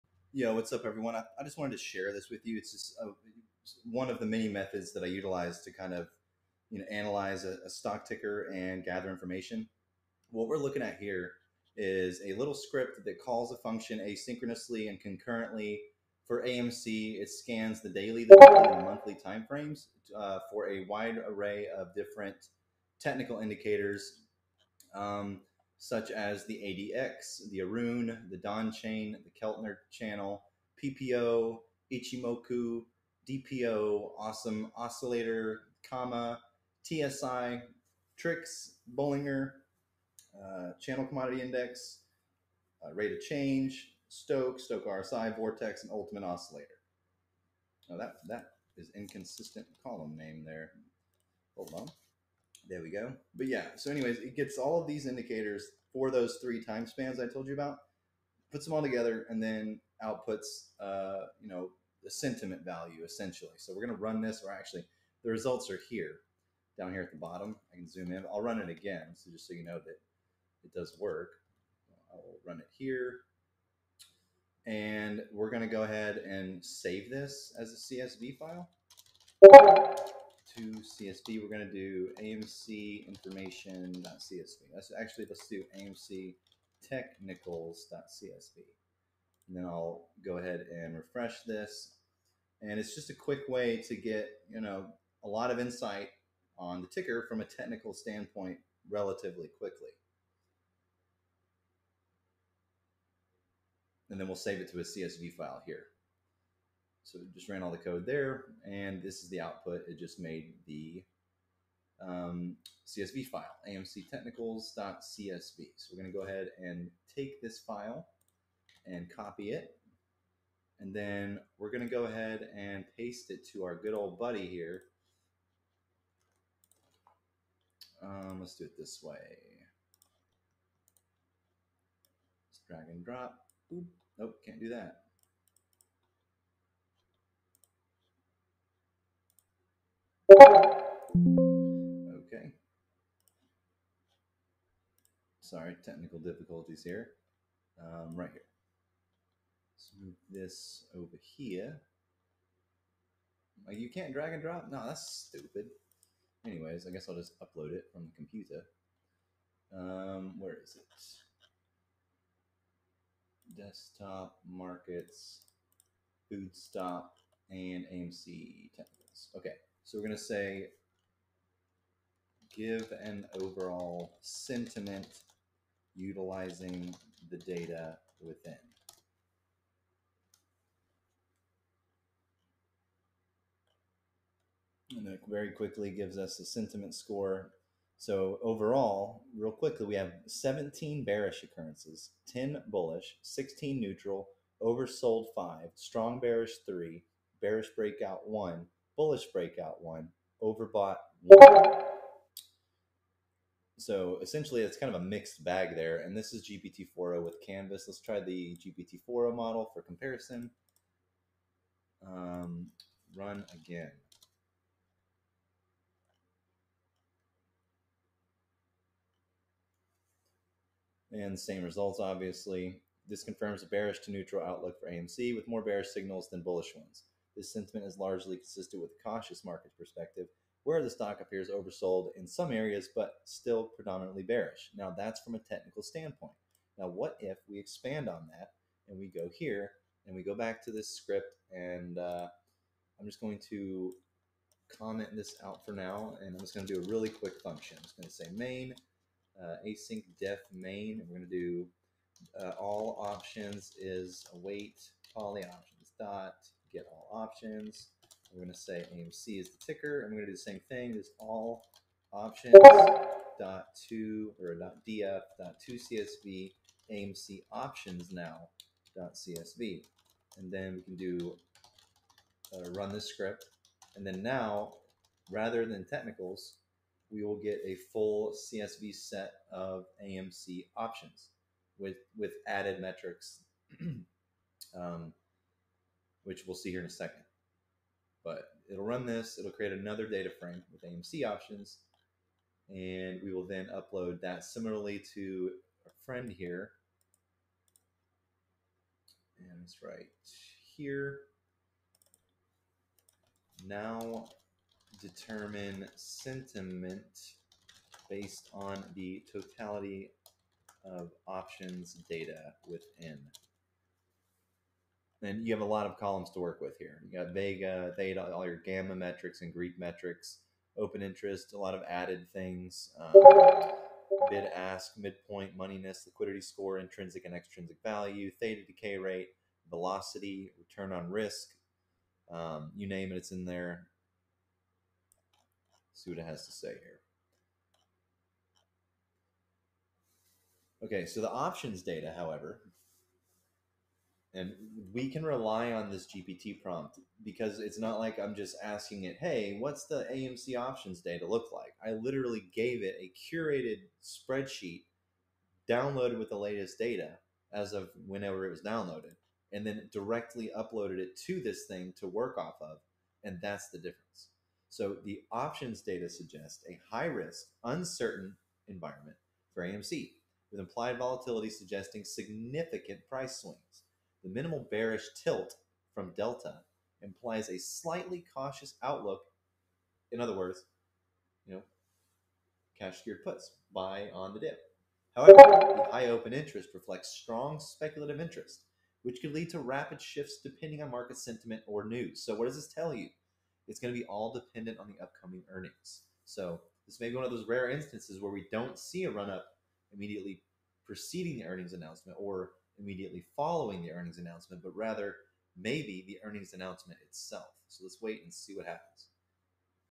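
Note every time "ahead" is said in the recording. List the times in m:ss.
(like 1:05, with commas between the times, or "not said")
1:15, 1:30, 1:56, 2:02.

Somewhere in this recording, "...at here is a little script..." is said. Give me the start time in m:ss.
0:10.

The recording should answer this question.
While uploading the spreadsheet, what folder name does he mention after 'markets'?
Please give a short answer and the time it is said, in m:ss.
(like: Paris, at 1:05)
foodstop, at 2:46.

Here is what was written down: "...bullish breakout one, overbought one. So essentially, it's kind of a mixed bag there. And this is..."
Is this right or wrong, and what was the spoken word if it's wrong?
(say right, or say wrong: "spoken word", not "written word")
right.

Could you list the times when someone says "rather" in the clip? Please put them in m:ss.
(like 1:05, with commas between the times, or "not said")
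4:35, 6:44.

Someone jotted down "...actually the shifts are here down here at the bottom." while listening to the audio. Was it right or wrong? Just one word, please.
wrong.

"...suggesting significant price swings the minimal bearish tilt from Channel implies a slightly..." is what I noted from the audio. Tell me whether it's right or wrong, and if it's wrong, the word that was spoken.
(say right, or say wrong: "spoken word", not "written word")
wrong: "Delta", not "Channel".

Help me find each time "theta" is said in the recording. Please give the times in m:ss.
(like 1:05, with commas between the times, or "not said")
5:17, 5:28.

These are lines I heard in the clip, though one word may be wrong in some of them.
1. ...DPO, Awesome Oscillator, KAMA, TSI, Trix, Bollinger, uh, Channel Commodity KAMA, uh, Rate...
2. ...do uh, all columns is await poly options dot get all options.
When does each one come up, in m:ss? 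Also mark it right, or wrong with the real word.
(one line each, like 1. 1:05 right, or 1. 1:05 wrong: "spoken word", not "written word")
1. 0:33 wrong: "Index", not "KAMA"
2. 4:11 wrong: "options", not "columns".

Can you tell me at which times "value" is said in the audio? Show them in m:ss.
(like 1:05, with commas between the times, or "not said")
1:02, 5:27.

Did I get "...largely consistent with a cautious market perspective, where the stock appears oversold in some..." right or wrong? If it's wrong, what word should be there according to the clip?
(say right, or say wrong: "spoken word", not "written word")
right.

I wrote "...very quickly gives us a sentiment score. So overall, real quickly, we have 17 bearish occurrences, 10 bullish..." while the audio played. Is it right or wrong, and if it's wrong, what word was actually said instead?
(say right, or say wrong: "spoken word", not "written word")
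right.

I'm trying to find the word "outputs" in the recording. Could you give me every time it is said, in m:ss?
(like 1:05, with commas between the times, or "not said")
1:00, 1:49.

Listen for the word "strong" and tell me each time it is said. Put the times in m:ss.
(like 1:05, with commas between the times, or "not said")
3:15, 6:27.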